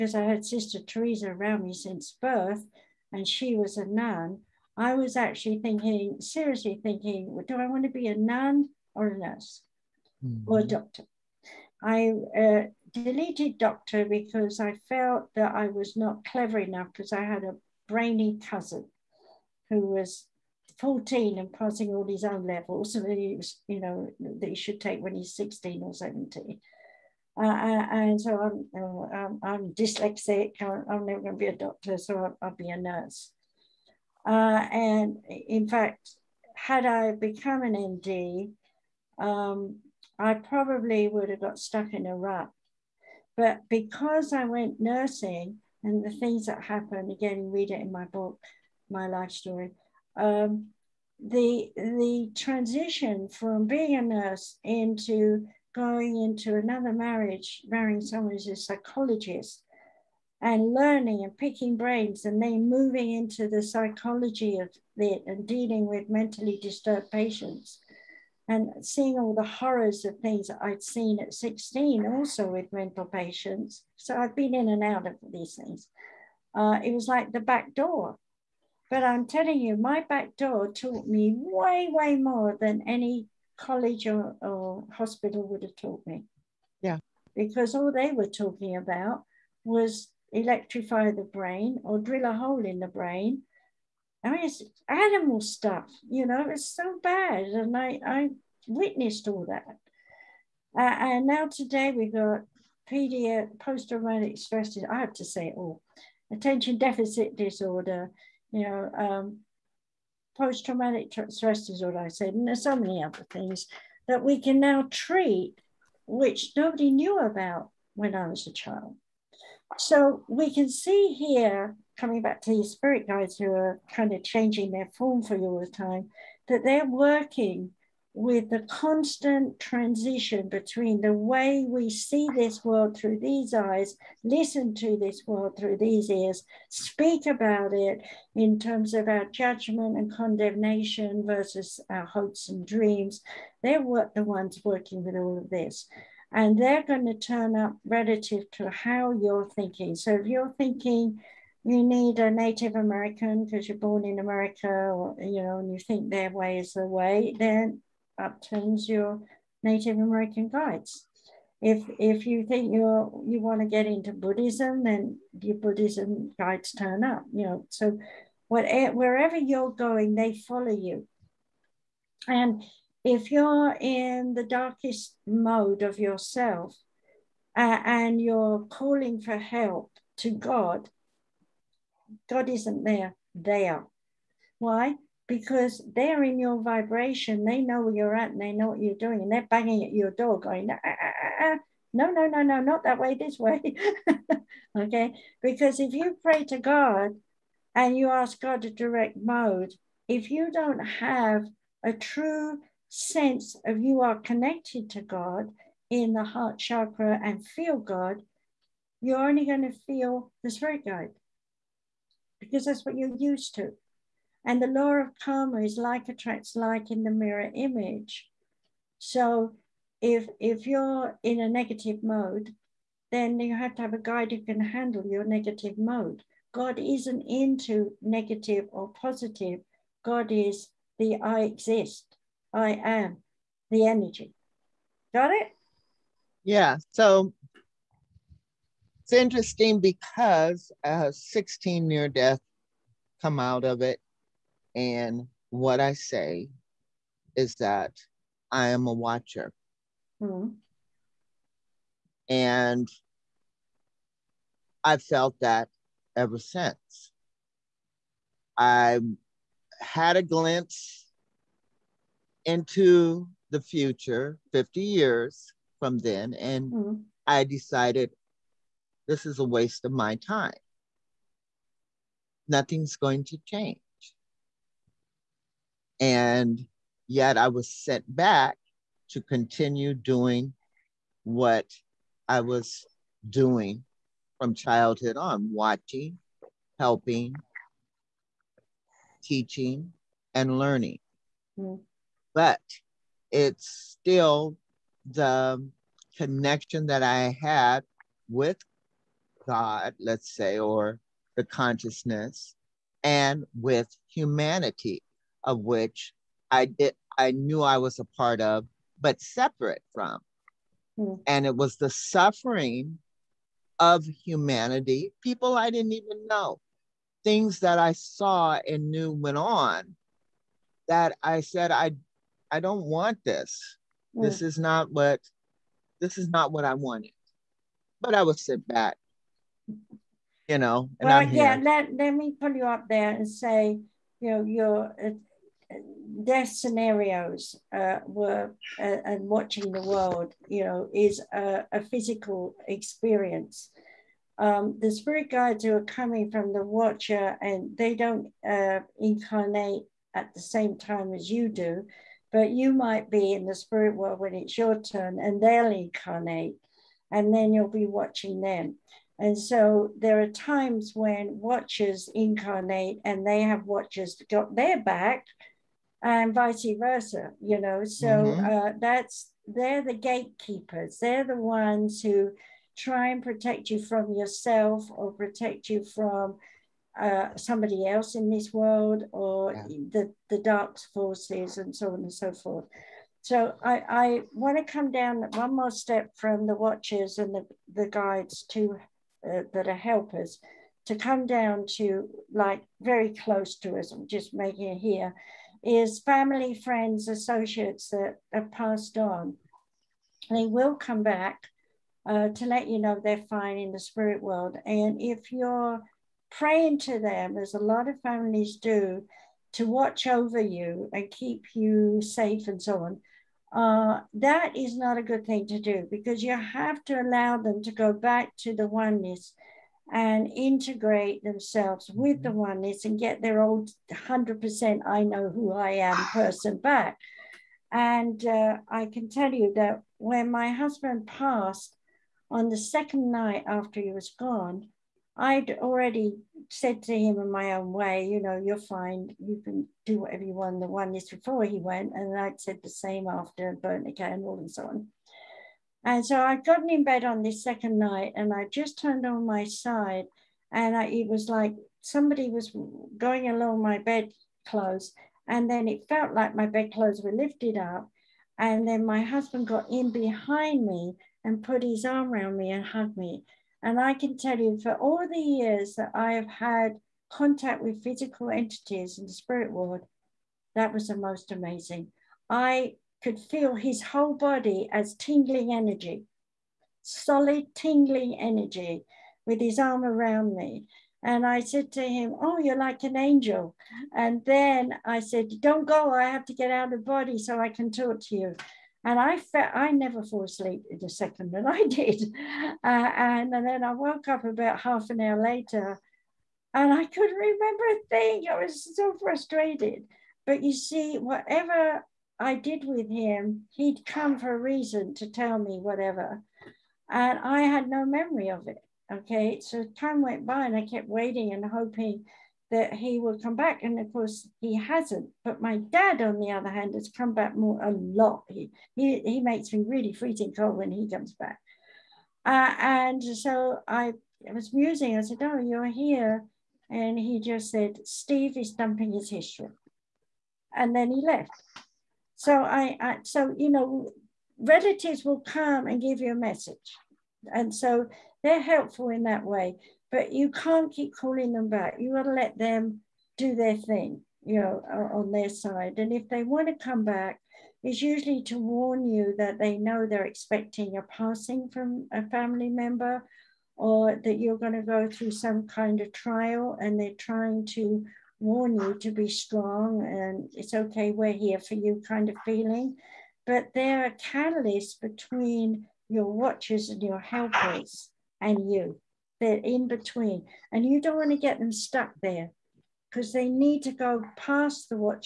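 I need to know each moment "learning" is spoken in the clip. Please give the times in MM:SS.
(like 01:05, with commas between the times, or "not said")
01:00, 04:50.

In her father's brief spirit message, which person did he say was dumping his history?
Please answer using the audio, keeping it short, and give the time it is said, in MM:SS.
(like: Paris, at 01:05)
Steve, at 08:47.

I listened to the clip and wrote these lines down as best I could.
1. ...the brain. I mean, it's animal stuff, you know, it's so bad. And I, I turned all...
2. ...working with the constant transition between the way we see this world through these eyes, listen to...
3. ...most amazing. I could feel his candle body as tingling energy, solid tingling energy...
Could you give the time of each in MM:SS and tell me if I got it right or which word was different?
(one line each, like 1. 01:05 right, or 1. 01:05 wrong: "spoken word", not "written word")
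1. 01:32 wrong: "witnessed", not "turned"
2. 02:06 right
3. 07:50 wrong: "whole", not "candle".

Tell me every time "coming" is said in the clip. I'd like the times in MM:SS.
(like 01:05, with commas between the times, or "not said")
02:01, 05:45.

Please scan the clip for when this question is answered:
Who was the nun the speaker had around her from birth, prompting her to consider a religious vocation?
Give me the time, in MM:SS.
00:00.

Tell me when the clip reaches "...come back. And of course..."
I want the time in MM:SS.
08:33.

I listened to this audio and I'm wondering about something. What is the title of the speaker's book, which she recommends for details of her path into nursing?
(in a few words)
My Life Story.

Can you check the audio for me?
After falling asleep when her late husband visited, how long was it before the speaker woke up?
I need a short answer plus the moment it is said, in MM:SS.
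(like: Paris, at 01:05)
Half an hour, at 08:14.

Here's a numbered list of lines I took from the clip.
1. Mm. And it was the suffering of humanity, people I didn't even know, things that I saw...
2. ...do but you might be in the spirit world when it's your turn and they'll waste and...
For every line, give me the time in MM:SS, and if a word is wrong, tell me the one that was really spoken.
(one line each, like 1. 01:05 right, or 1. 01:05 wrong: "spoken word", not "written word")
1. 05:10 right
2. 05:51 wrong: "incarnate", not "waste".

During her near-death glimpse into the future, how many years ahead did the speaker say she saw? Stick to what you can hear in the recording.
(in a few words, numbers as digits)
50 years.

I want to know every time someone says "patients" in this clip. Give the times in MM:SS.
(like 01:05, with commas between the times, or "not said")
01:07, 01:13.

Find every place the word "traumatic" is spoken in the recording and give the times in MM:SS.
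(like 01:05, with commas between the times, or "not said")
01:43, 01:50.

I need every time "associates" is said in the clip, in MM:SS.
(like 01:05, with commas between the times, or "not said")
06:37.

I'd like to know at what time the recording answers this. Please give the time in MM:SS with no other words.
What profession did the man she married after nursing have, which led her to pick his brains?
00:58.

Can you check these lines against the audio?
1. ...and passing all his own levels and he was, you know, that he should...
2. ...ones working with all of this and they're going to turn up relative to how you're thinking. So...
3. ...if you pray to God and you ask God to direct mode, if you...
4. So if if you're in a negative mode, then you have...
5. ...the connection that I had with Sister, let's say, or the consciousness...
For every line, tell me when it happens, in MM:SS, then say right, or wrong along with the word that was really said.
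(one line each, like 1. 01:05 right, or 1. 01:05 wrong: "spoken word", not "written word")
1. 00:21 right
2. 02:24 right
3. 03:15 right
4. 03:38 right
5. 04:55 wrong: "God", not "Sister".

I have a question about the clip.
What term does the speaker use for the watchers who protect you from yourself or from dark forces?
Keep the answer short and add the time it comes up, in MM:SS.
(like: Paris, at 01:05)
Gatekeepers, at 06:09.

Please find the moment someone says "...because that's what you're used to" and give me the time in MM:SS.
03:32.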